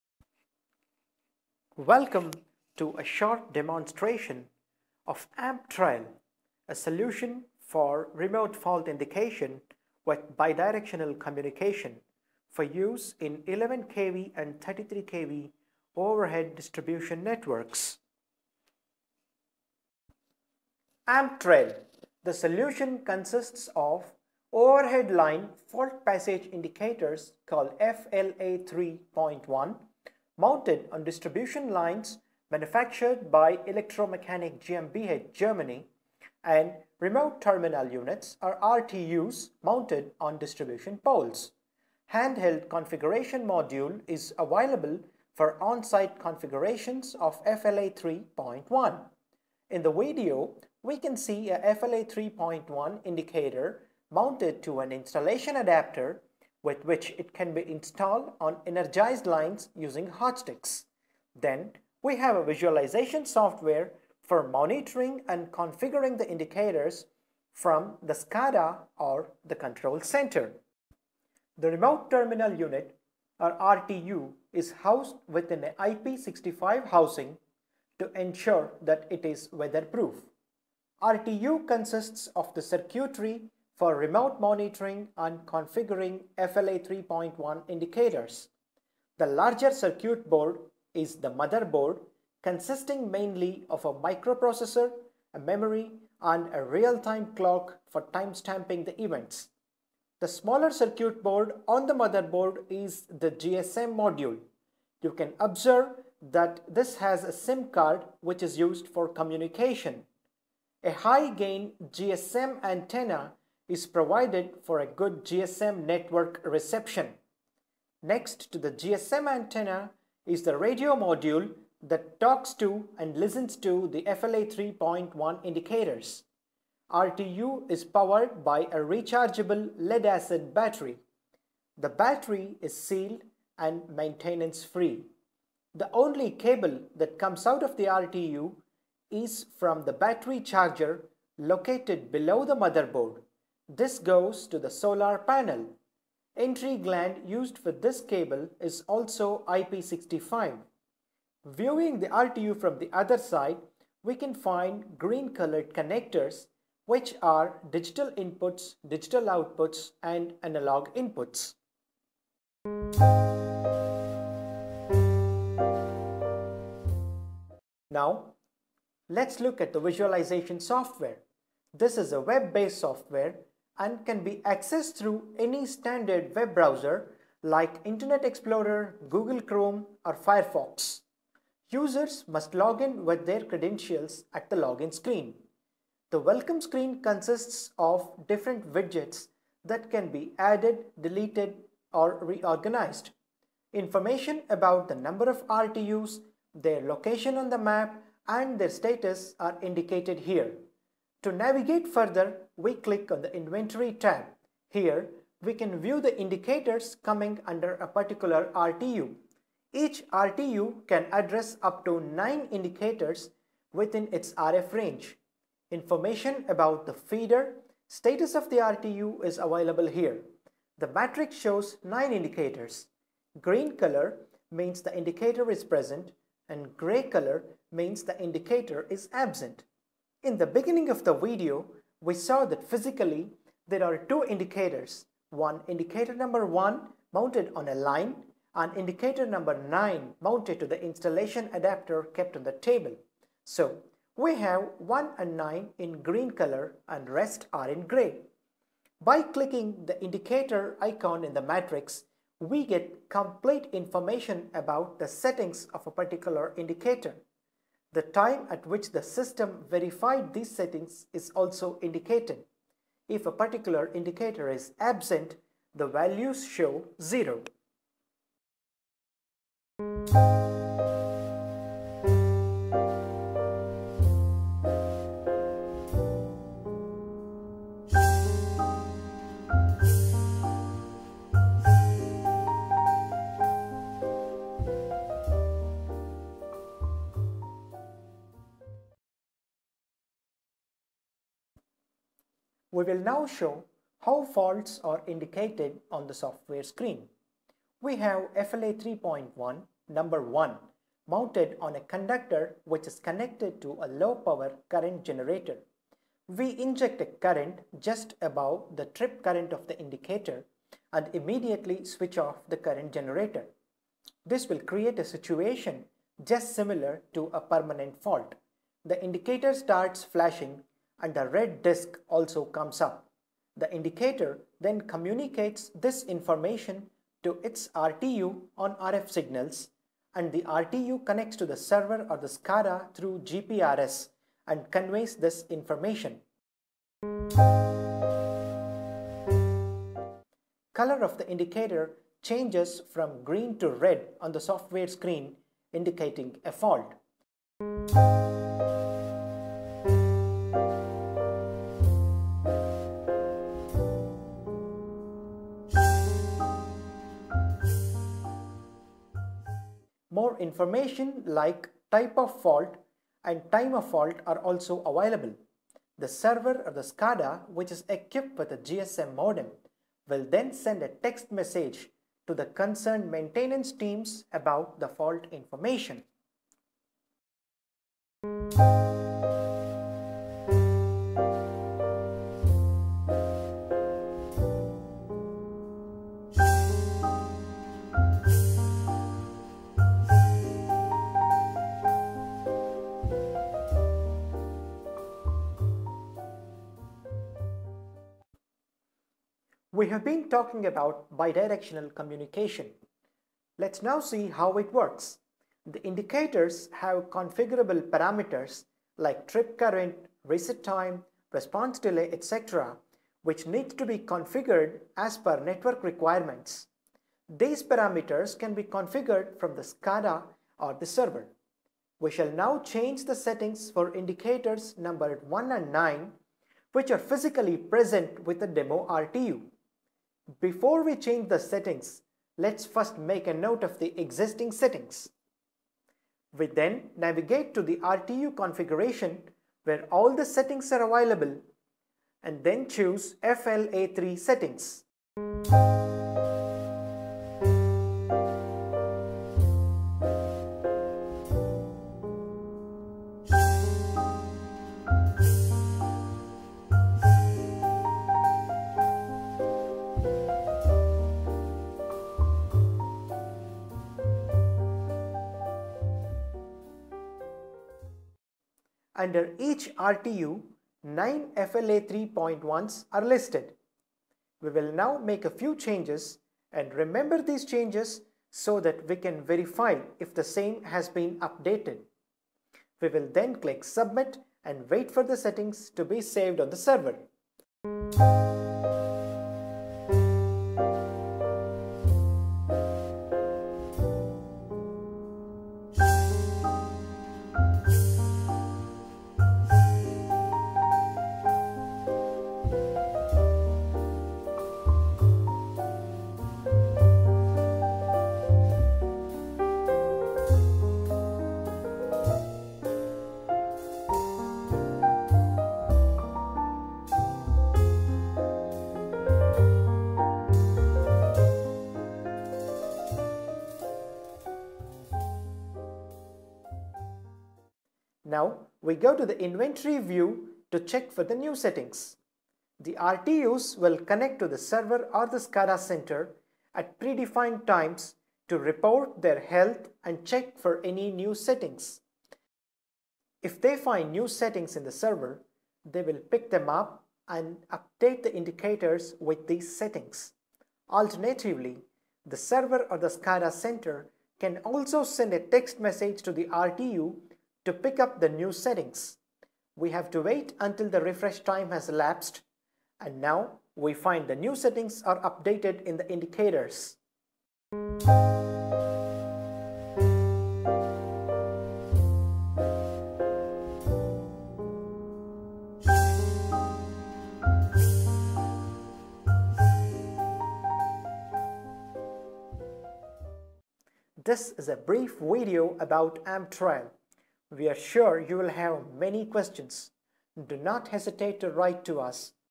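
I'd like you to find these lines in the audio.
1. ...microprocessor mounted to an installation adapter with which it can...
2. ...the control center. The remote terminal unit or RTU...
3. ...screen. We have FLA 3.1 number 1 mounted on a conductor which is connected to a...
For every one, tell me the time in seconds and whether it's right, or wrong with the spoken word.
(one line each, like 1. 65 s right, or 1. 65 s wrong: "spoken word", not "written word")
1. 53 s wrong: "indicator", not "microprocessor"
2. 69 s right
3. 296 s right.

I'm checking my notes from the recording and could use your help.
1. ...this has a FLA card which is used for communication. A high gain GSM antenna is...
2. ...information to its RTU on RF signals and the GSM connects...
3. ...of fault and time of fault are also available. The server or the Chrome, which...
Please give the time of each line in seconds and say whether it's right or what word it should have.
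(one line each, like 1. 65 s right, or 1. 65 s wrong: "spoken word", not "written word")
1. 106 s wrong: "SIM", not "FLA"
2. 326 s wrong: "RTU", not "GSM"
3. 362 s wrong: "SCADA", not "Chrome".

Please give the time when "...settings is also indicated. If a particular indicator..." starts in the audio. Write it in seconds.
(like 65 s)
260 s.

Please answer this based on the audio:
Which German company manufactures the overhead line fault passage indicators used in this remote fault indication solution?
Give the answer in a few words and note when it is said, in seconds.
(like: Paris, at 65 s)
Electromechanic GmbH, at 33 s.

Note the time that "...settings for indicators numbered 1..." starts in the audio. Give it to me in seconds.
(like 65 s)
423 s.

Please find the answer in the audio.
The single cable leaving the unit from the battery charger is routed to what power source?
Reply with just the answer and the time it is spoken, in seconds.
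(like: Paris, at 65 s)
solar panel, at 144 s.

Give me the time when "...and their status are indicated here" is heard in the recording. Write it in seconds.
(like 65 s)
198 s.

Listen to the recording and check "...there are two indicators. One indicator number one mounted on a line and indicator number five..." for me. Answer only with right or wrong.
wrong.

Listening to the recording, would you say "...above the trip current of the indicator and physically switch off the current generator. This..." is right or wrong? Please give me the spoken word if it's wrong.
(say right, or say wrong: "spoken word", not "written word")
wrong: "immediately", not "physically".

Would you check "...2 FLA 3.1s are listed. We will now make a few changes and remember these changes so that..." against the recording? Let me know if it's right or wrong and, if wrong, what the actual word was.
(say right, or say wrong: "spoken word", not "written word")
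wrong: "9", not "2".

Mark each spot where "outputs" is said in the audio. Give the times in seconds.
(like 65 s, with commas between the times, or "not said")
159 s.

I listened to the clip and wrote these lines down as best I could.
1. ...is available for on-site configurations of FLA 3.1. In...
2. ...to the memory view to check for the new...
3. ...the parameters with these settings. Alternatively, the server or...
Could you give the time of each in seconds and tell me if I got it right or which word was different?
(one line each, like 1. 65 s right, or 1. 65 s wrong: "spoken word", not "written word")
1. 44 s right
2. 528 s wrong: "inventory", not "memory"
3. 548 s wrong: "indicators", not "parameters".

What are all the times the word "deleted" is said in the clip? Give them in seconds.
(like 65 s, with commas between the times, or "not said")
190 s.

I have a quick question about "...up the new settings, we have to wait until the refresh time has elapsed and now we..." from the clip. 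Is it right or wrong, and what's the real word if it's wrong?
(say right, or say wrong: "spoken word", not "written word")
right.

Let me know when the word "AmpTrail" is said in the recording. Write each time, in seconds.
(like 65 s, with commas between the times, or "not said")
5 s, 21 s, 586 s.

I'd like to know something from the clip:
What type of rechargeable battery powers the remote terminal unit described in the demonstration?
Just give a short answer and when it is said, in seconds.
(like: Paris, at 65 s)
lead acid battery, at 129 s.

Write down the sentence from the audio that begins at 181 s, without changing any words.
Users must log in with their credentials at the login screen.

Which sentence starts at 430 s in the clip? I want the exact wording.
Before we change the settings, let's first make a note of the existing settings.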